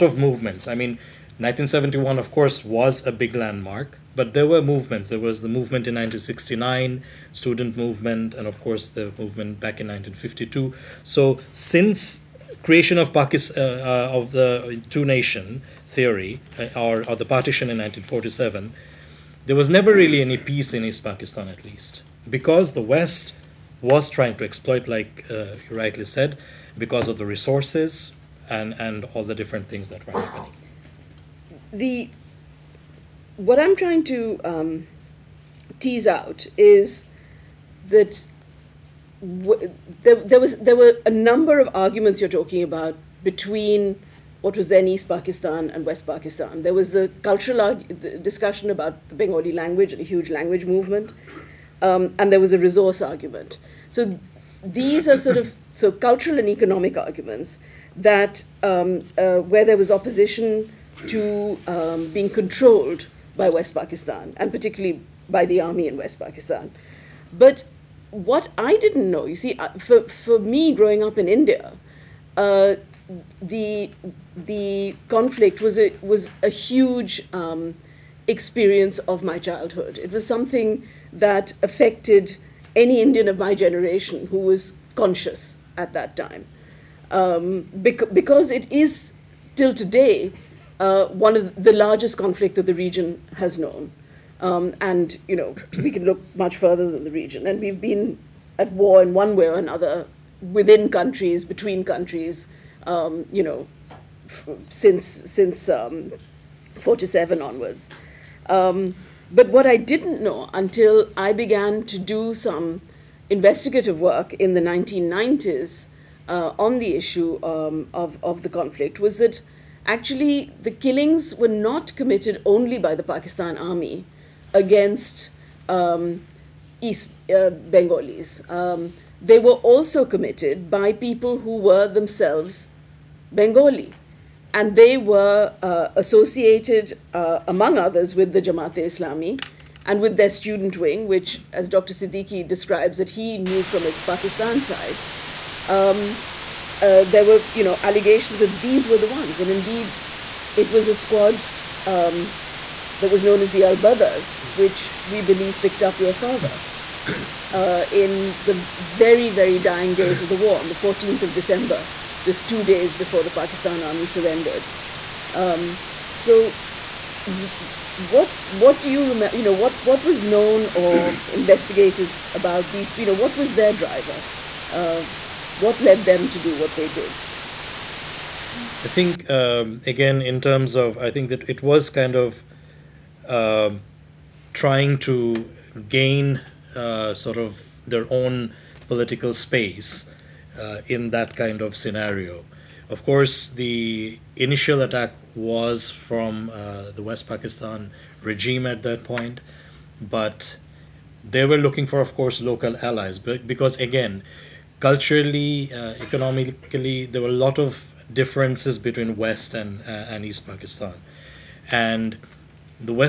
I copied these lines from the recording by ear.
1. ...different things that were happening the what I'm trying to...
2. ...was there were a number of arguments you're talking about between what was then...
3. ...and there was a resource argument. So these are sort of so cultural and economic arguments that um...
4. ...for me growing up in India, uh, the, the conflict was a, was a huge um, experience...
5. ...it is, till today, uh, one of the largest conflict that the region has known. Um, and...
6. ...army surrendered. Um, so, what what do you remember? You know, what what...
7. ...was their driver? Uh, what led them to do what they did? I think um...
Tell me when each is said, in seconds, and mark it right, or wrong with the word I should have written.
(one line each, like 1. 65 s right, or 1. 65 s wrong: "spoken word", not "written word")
1. 29 s right
2. 40 s right
3. 52 s right
4. 70 s right
5. 88 s right
6. 163 s right
7. 173 s right.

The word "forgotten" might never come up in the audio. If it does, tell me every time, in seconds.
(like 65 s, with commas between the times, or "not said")
not said.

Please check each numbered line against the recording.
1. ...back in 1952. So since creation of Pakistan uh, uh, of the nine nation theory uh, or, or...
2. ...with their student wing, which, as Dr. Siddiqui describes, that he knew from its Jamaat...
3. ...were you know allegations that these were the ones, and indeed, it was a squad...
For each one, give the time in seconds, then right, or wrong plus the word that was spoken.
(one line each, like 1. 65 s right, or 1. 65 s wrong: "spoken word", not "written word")
1. 9 s wrong: "two", not "nine"
2. 139 s wrong: "Pakistan", not "Jamaat"
3. 147 s right.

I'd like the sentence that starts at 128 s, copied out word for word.
Um, they were also committed by people who were themselves Bengali.